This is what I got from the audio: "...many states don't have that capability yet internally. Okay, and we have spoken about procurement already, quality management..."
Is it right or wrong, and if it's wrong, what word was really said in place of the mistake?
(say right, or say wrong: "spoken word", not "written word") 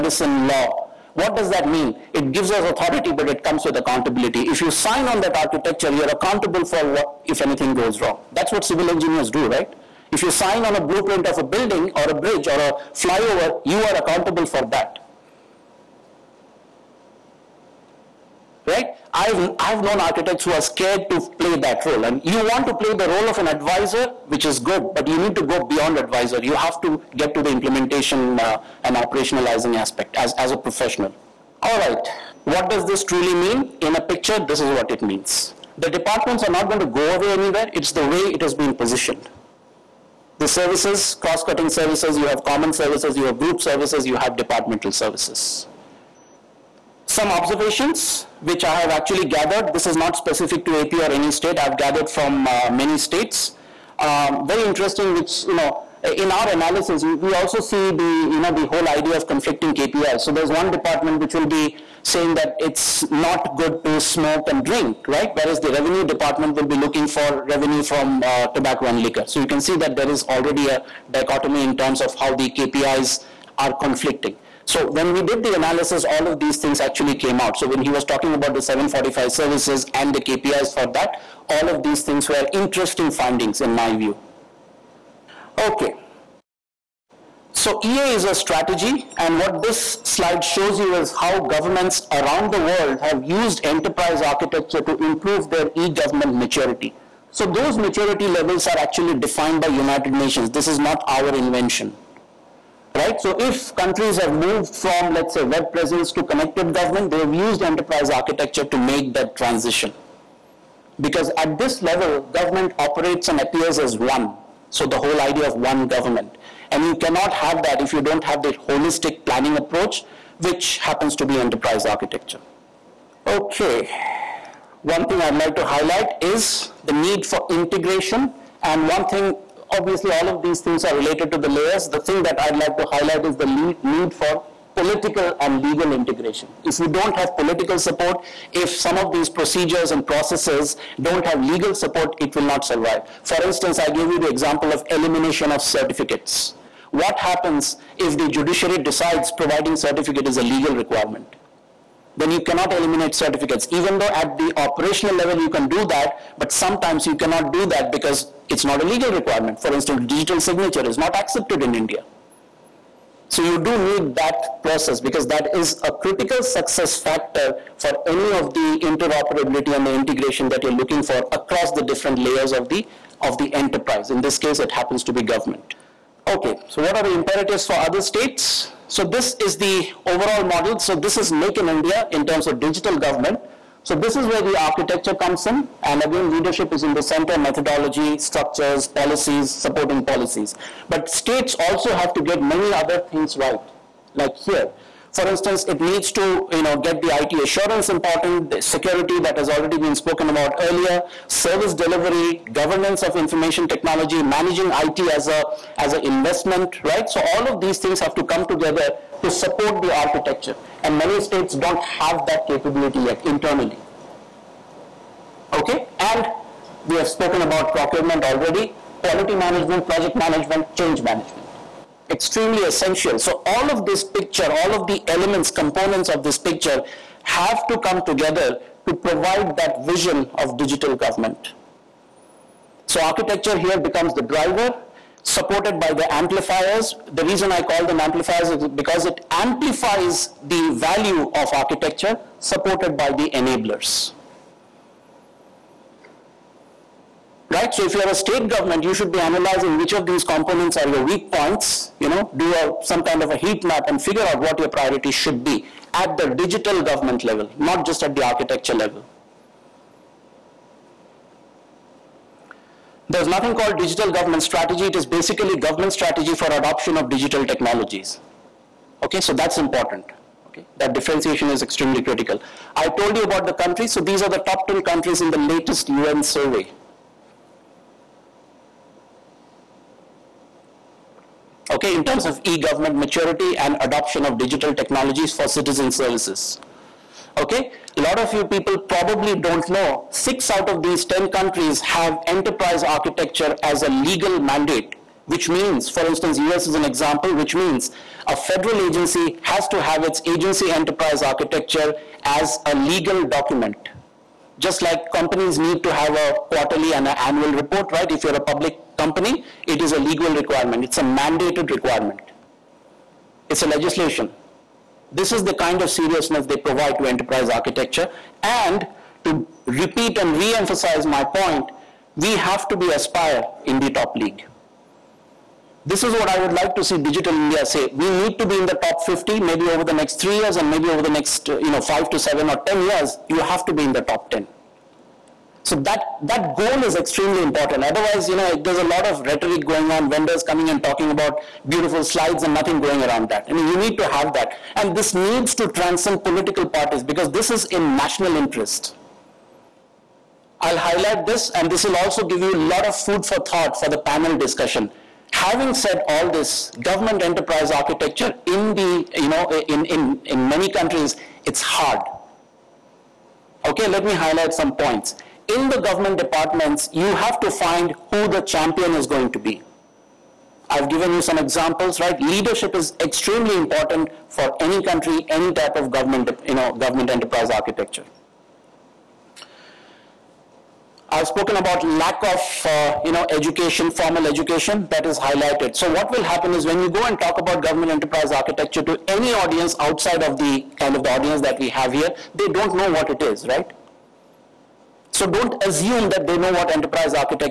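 right.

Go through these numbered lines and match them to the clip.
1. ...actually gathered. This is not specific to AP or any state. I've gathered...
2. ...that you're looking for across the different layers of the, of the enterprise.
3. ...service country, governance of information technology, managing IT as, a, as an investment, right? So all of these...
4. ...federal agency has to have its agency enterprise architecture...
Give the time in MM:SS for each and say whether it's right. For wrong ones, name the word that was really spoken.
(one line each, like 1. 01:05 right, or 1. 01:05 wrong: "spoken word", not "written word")
1. 00:48 right
2. 02:50 right
3. 03:21 wrong: "delivery", not "country"
4. 04:58 right.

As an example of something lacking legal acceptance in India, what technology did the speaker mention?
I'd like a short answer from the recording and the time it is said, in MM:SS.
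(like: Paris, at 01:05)
digital signature, at 02:40.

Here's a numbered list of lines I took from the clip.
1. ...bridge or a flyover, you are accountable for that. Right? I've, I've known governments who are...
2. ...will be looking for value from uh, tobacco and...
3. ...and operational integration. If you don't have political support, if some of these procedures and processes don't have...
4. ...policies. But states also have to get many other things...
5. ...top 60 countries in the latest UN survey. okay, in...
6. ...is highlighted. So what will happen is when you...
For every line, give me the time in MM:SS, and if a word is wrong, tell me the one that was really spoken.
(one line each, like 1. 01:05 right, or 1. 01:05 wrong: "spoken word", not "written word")
1. 00:12 wrong: "architects", not "governments"
2. 01:06 wrong: "revenue", not "value"
3. 02:15 wrong: "legal", not "operational"
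4. 03:10 right
5. 04:34 wrong: "10", not "60"
6. 06:25 right.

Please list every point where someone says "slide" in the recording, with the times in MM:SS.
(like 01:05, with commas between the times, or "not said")
01:30, 05:42.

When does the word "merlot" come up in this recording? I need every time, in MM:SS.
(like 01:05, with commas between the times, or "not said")
not said.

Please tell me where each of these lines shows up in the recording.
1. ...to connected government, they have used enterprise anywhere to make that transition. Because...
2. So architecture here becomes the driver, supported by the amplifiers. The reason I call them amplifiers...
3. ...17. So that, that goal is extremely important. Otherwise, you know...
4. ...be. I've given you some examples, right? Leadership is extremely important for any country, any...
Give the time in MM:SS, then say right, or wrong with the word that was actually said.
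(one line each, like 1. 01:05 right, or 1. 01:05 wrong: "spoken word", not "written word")
1. 01:46 wrong: "architecture", not "anywhere"
2. 03:52 right
3. 05:34 wrong: "10", not "17"
4. 06:09 right.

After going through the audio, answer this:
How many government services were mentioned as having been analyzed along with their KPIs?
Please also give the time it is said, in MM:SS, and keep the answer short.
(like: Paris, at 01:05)
745, at 01:18.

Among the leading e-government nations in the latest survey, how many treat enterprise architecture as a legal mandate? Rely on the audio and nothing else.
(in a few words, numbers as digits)
6.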